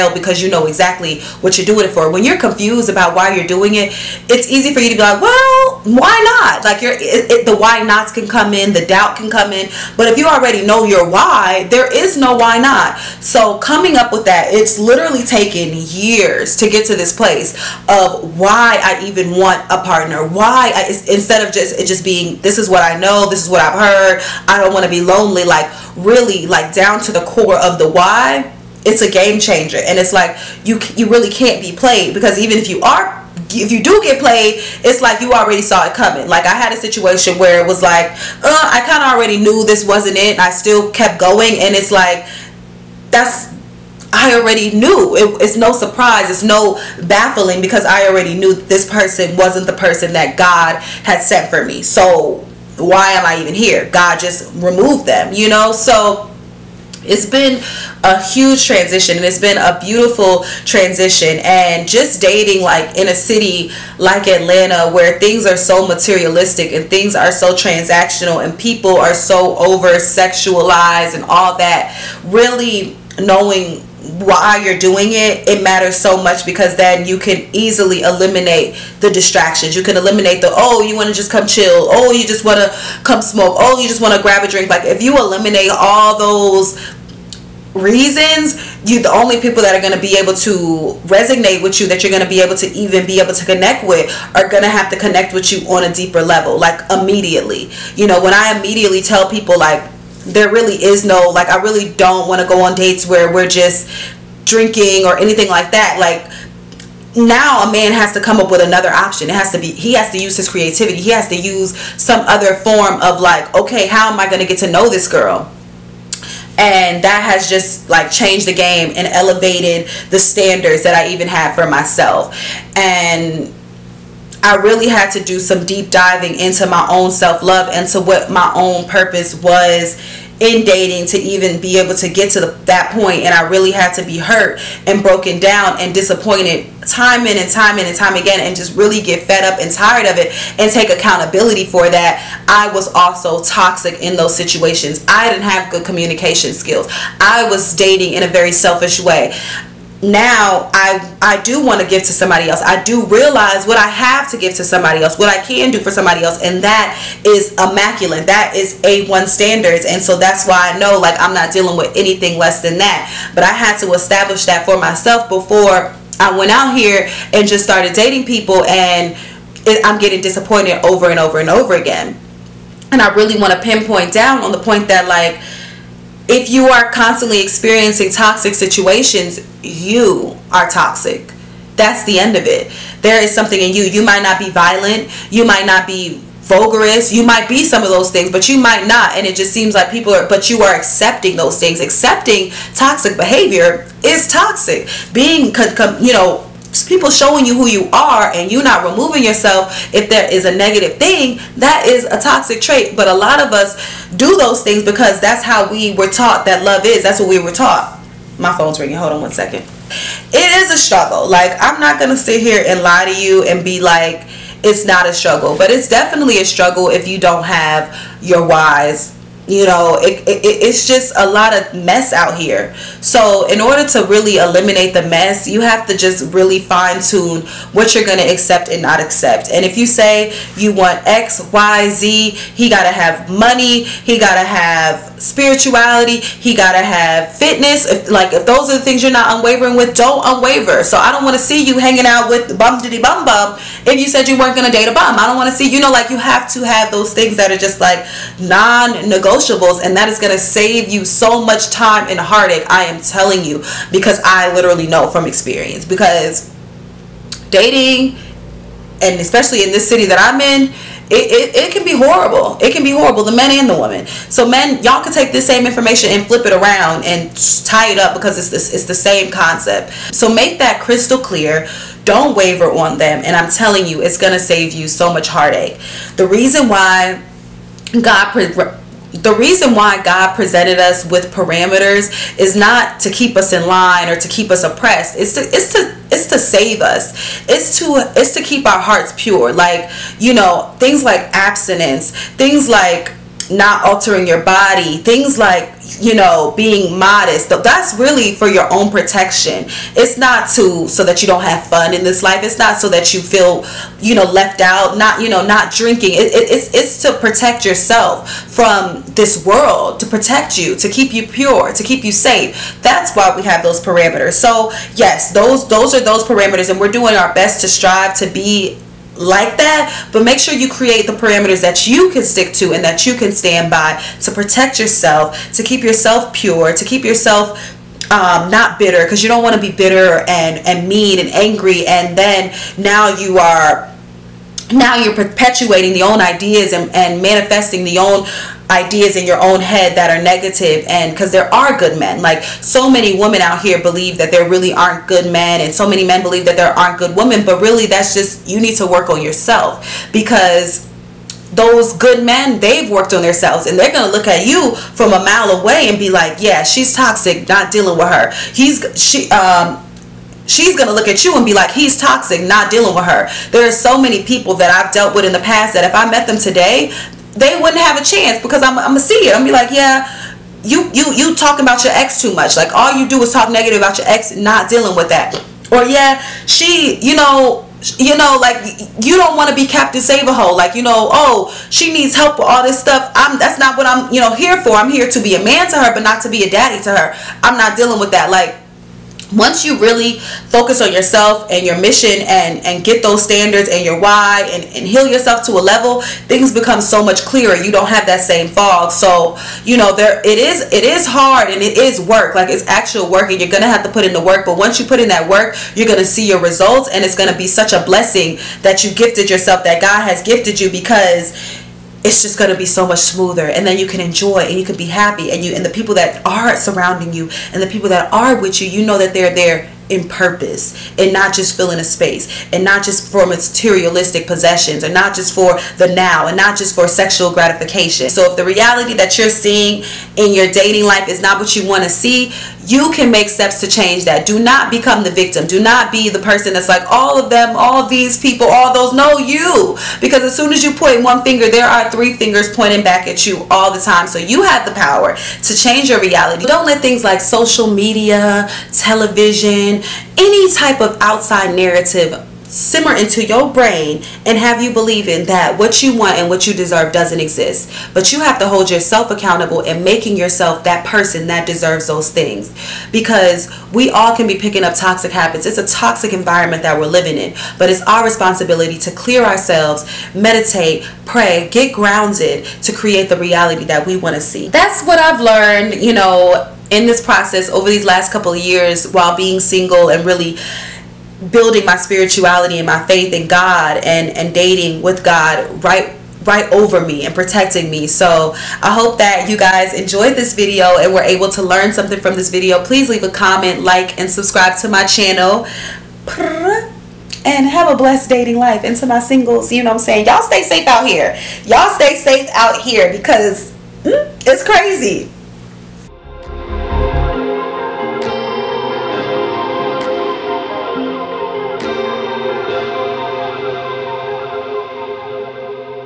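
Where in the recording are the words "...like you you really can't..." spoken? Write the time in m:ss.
0:30.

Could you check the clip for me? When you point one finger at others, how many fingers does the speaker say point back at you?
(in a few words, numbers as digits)
3.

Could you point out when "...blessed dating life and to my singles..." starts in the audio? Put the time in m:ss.
8:17.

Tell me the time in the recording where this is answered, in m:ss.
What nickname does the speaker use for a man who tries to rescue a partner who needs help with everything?
6:19.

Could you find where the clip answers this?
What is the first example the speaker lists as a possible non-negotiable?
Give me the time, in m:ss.
3:53.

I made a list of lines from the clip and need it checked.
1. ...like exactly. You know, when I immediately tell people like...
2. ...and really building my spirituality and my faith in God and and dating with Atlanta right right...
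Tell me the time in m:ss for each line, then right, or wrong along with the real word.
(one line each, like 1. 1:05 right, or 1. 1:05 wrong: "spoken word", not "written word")
1. 1:36 wrong: "immediately", not "exactly"
2. 7:59 wrong: "God", not "Atlanta".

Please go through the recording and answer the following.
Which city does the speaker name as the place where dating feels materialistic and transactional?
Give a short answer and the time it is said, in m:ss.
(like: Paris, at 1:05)
Atlanta, at 1:04.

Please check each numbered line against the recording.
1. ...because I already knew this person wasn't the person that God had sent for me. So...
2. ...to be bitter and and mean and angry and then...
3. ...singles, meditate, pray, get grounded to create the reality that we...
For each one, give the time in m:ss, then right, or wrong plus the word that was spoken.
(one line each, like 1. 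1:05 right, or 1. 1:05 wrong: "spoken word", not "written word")
1. 0:47 right
2. 5:29 right
3. 7:49 wrong: "ourselves", not "singles".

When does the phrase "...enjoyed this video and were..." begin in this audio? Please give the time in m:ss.
8:09.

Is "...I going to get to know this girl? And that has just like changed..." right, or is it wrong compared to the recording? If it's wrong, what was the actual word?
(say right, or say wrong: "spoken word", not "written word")
right.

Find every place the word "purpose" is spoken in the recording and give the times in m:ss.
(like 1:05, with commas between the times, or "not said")
2:08, 7:00.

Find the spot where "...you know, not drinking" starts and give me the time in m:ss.
5:05.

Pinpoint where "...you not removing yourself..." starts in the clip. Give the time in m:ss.
3:18.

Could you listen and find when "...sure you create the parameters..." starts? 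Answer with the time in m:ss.
5:20.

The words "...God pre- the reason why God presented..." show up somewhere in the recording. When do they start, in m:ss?
4:38.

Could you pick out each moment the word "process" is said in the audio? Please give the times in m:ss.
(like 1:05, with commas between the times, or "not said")
7:57.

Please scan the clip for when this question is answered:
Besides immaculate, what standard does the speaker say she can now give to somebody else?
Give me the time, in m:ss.
2:38.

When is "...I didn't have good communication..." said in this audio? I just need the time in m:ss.
2:25.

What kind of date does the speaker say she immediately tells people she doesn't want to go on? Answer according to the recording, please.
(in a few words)
Dates where we're just drinking.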